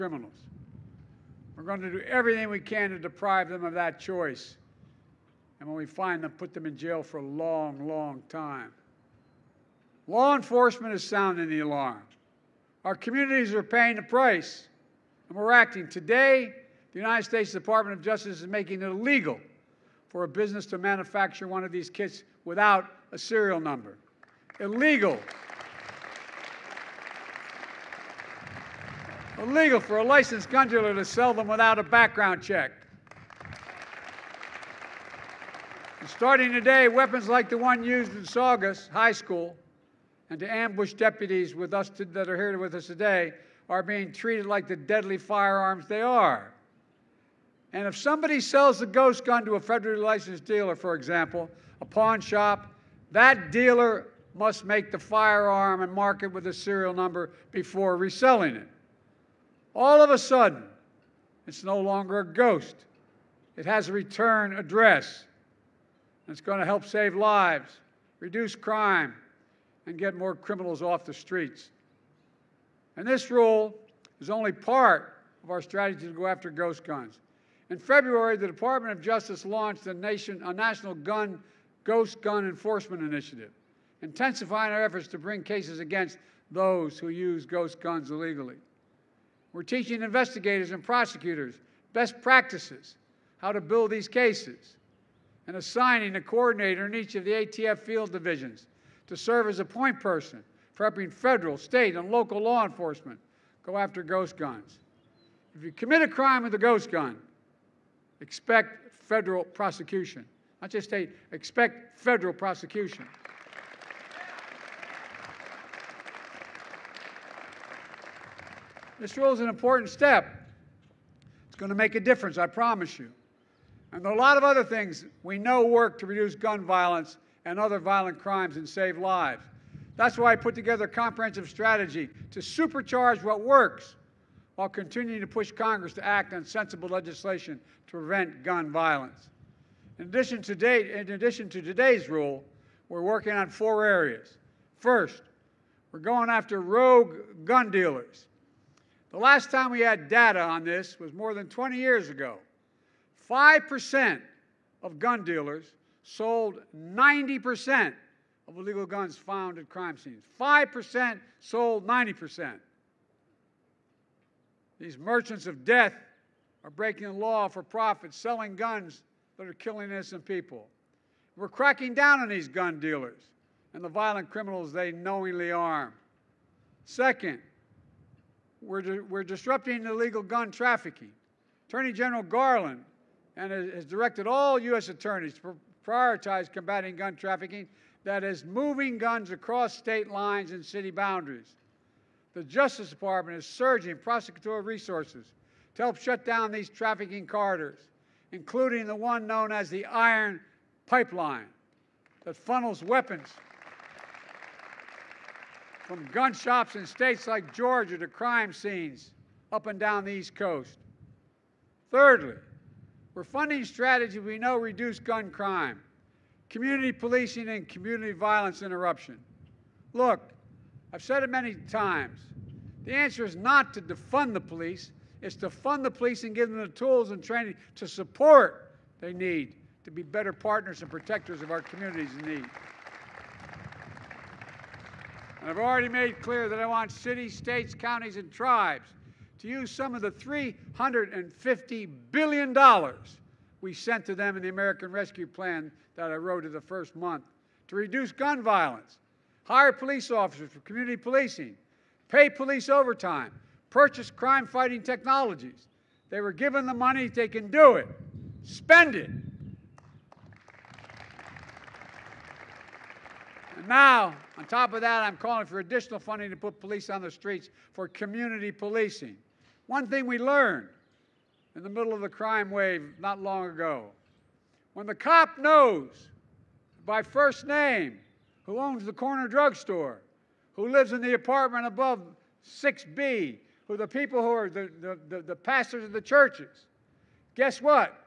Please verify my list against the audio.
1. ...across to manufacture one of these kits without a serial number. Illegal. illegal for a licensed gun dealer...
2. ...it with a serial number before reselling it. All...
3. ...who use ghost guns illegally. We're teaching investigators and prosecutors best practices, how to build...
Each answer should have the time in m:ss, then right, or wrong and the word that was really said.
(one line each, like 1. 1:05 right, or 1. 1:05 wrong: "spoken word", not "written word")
1. 0:20 wrong: "business", not "across"
2. 0:56 right
3. 1:26 right.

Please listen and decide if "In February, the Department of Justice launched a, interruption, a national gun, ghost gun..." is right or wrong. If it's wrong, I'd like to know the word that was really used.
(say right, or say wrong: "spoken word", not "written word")
wrong: "nation", not "interruption".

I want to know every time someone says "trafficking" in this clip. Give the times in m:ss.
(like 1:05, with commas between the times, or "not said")
3:00, 3:07, 3:16.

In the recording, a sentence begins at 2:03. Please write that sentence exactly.
And there are a lot of other things we know work to reduce gun violence and other violent crimes and save lives.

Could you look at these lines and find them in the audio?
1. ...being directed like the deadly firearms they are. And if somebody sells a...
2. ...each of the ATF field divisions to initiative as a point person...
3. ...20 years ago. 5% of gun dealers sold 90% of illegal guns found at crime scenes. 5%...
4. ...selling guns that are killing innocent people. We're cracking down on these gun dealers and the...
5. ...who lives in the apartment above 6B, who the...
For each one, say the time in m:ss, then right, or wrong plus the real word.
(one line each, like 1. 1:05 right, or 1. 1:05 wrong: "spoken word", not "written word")
1. 0:43 wrong: "treated", not "directed"
2. 1:36 wrong: "serve", not "initiative"
3. 2:31 right
4. 2:48 right
5. 4:40 right.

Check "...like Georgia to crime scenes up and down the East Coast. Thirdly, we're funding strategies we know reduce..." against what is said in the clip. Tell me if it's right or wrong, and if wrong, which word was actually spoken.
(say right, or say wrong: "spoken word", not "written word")
right.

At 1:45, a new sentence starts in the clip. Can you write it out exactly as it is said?
If you commit a crime with a ghost gun, expect federal prosecution.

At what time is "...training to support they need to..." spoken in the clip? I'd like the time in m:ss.
3:47.